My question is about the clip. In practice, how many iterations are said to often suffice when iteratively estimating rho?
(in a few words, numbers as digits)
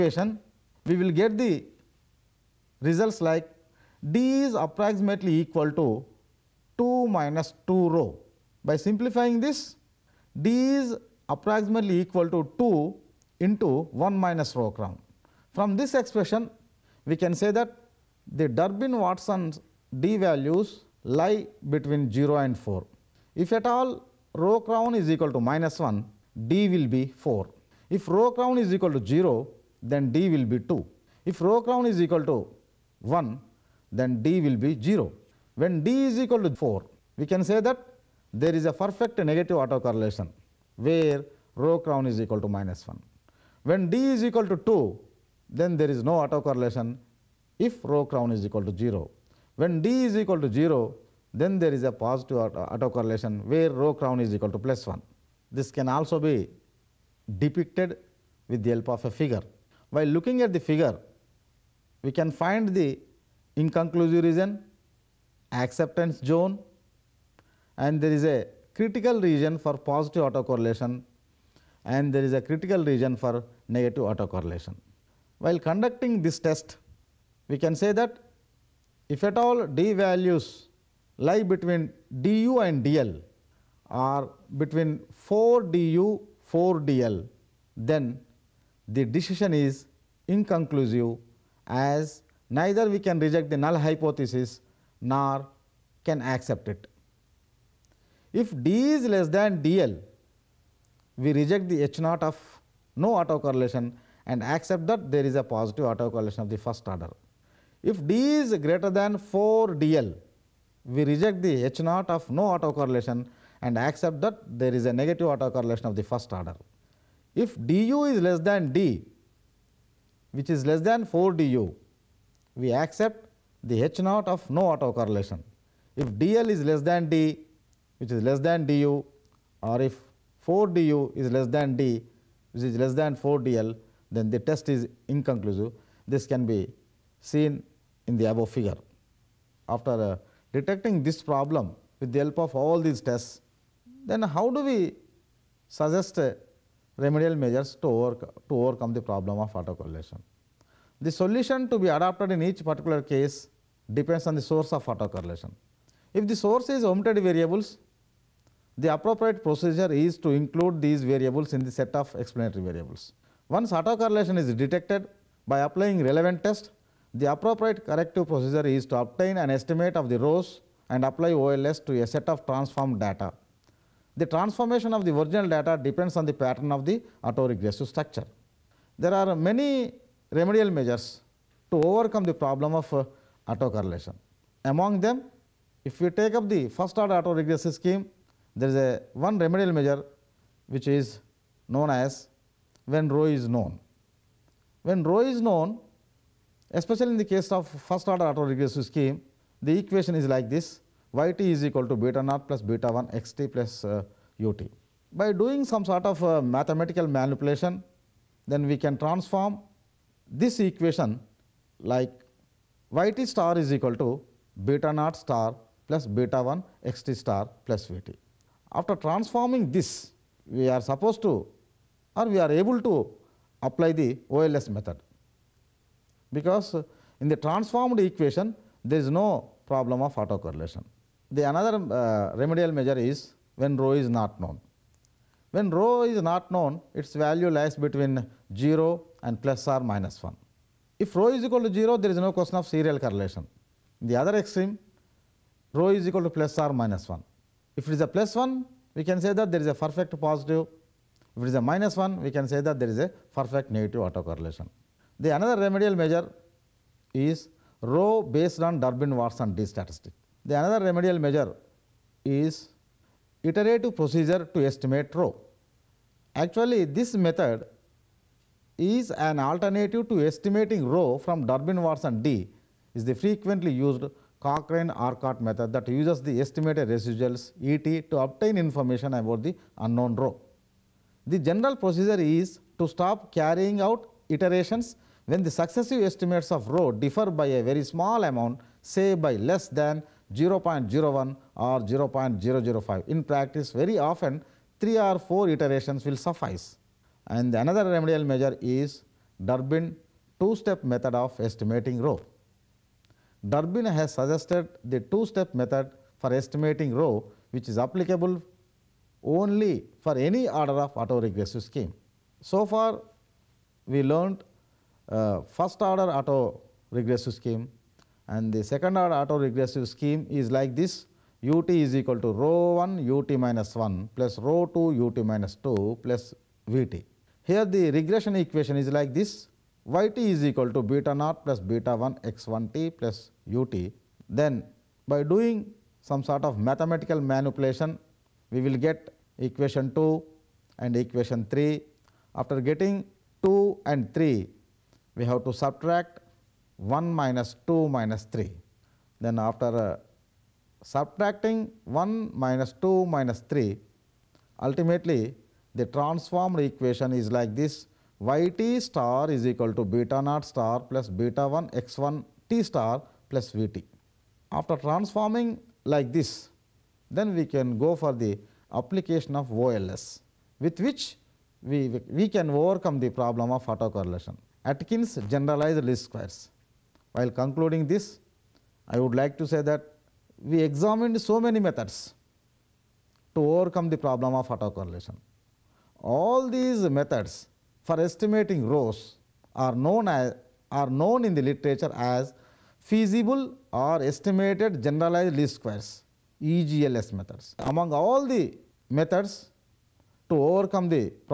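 3 or 4.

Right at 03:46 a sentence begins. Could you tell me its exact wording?
Because in the transformed equation, there is no problem of autocorrelation.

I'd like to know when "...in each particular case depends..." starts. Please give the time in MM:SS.
02:32.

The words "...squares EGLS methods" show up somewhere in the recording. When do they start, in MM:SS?
06:35.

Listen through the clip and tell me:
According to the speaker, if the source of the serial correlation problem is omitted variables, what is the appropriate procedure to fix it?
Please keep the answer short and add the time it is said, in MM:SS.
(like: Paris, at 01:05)
include these variables, at 02:40.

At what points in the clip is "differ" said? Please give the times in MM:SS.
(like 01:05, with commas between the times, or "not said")
04:46.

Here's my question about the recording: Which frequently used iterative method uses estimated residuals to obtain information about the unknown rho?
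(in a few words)
Cochrane-Orcutt method.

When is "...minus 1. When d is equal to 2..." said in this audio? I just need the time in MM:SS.
00:42.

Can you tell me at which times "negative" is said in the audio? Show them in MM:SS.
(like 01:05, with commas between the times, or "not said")
00:39, 01:13, 01:54, 04:13.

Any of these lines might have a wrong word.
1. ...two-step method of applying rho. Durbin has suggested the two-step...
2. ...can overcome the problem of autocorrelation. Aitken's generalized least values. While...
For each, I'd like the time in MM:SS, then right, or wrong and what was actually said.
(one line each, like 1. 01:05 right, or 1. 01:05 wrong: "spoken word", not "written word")
1. 05:00 wrong: "estimating", not "applying"
2. 06:12 wrong: "squares", not "values".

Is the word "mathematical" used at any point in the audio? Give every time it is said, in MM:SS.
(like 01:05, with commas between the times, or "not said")
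03:26, 05:36.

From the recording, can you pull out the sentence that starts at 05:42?
After getting 2 and 3, we have to subtract 1 minus 2 minus 3.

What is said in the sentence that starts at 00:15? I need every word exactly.
From this expression, we can say that the Durbin-Watson d values lie between 0 and 4.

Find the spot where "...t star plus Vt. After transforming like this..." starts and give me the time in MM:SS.
06:02.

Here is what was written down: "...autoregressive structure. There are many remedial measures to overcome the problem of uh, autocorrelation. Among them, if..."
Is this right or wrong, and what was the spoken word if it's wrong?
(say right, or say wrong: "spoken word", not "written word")
right.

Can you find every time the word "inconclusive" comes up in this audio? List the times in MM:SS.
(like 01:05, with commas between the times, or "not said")
01:03, 01:30, 02:15.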